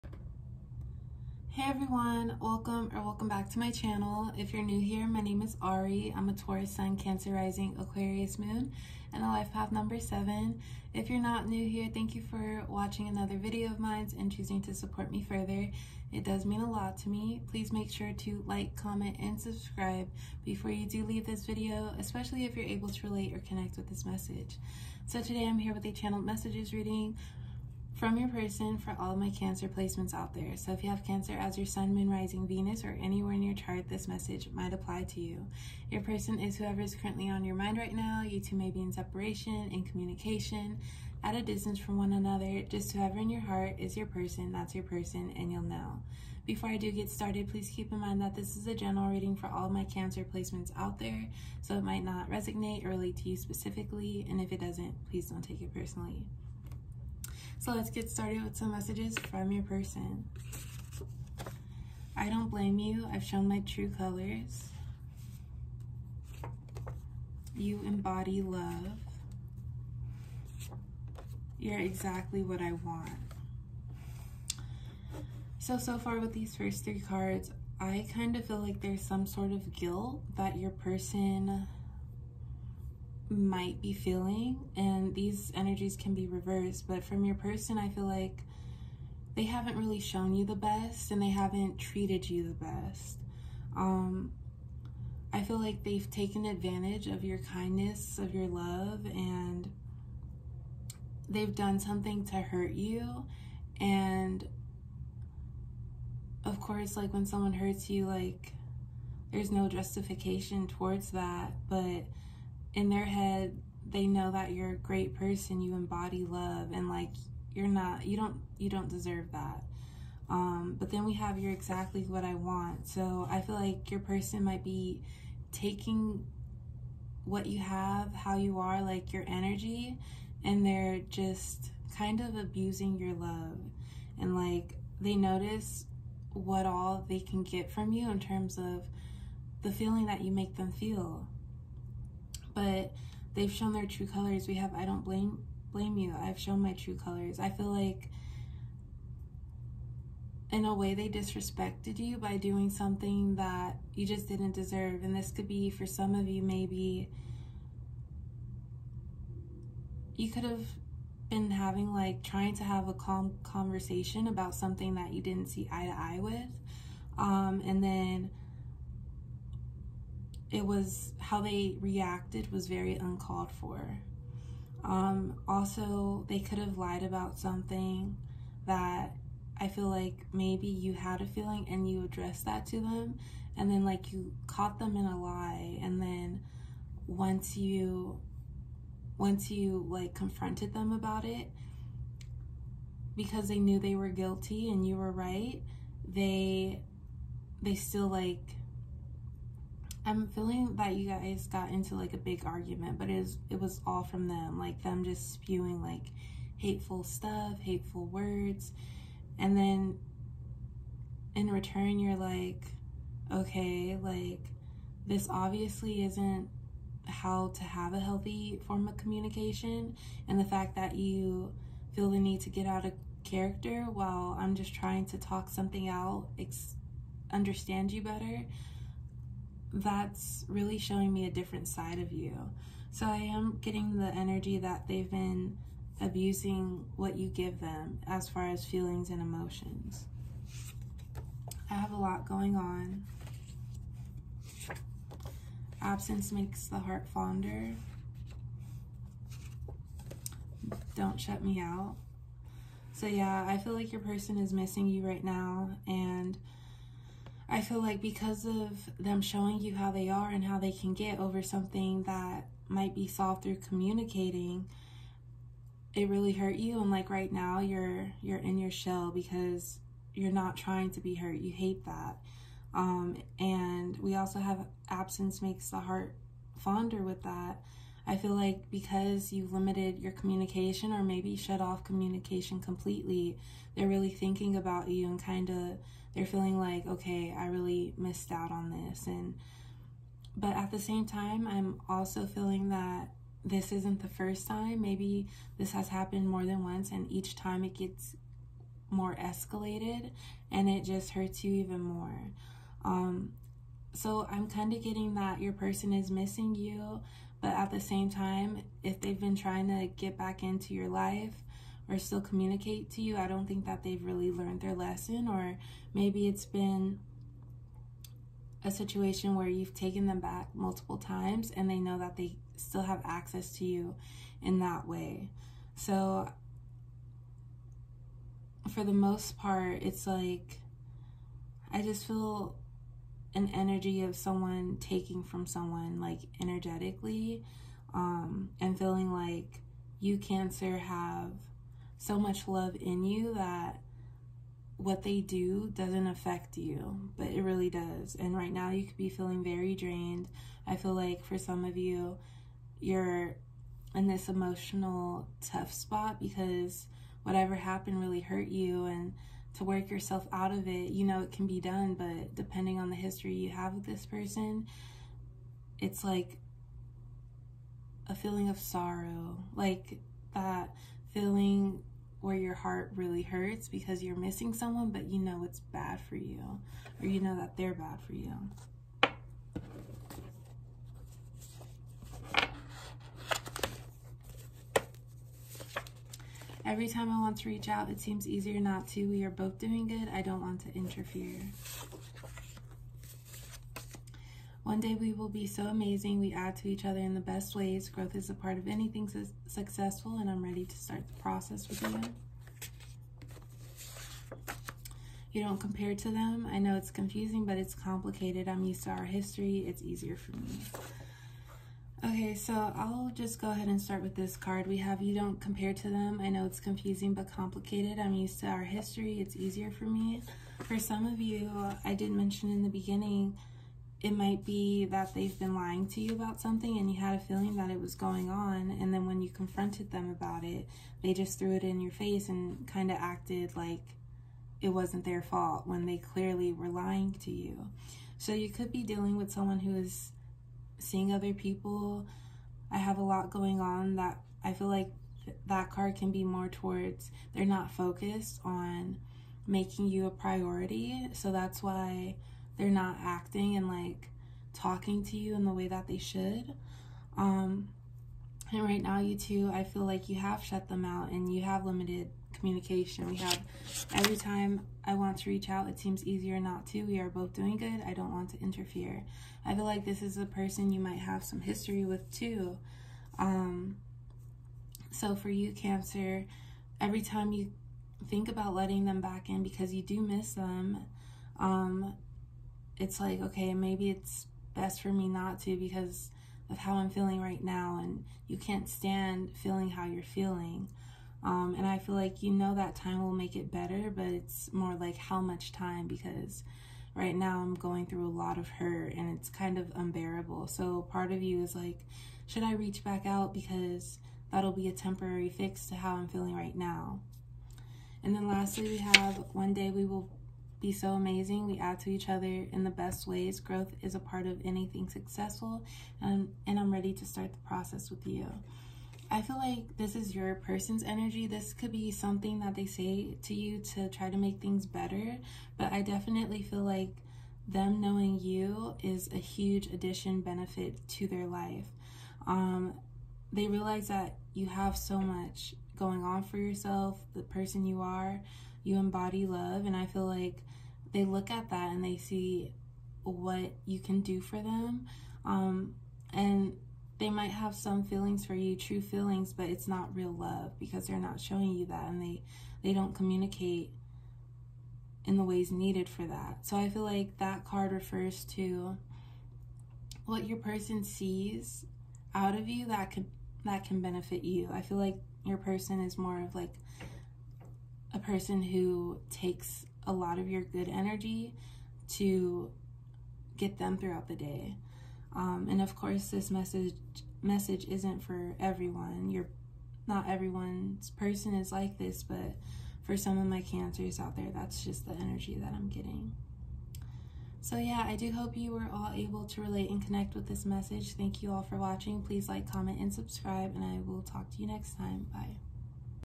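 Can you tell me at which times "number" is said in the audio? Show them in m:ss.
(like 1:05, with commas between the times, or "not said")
0:09.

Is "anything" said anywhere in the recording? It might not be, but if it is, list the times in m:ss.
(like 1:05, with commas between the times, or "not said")
6:38, 8:34.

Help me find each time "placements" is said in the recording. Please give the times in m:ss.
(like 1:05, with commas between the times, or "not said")
0:29, 0:50.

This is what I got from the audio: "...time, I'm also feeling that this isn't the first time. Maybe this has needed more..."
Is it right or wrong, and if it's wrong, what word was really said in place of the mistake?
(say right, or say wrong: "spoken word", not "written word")
wrong: "happened", not "needed".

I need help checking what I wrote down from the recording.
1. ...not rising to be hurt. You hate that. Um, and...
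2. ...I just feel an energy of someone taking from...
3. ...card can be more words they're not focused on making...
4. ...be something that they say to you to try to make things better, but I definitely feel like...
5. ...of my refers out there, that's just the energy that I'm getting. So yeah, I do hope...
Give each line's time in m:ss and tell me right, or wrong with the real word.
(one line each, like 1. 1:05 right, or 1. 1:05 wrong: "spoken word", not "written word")
1. 4:30 wrong: "trying", not "rising"
2. 5:31 right
3. 7:25 wrong: "towards", not "words"
4. 8:41 right
5. 9:43 wrong: "cancers", not "refers".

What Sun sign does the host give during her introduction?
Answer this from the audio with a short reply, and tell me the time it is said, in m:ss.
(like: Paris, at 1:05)
Taurus, at 0:06.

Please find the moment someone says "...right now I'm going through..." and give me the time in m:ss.
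8:16.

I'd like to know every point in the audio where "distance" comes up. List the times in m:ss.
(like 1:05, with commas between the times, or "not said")
0:41.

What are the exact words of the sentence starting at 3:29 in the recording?
And then in return, you're like, okay, like this obviously isn't how to have a healthy form of communication.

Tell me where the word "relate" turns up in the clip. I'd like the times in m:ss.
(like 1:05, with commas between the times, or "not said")
0:23, 0:52, 9:49.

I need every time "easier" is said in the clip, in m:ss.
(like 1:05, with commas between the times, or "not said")
6:28, 6:49, 6:59, 7:46.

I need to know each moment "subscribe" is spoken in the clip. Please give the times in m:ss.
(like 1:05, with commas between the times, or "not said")
0:19, 9:52.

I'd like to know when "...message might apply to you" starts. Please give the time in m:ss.
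0:34.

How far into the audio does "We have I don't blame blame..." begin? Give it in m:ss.
2:24.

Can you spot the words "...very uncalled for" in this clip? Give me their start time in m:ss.
2:52.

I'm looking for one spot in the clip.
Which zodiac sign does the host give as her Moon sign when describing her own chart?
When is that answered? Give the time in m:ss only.
0:07.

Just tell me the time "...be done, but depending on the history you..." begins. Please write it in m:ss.
6:01.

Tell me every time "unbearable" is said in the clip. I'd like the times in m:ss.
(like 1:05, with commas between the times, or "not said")
8:19.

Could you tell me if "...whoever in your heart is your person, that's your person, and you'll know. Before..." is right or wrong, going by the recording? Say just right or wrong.
right.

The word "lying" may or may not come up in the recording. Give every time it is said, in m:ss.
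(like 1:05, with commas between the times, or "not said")
7:05, 7:16.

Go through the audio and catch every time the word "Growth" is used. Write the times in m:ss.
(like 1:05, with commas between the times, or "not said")
6:37, 8:33.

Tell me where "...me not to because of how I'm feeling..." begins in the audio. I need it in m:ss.
8:04.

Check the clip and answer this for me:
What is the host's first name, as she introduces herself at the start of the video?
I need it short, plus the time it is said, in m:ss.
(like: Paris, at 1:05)
Ari, at 0:05.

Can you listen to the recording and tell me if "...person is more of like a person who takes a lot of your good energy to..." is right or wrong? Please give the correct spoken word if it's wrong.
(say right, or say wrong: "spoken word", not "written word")
right.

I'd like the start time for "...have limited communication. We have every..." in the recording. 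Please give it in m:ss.
7:41.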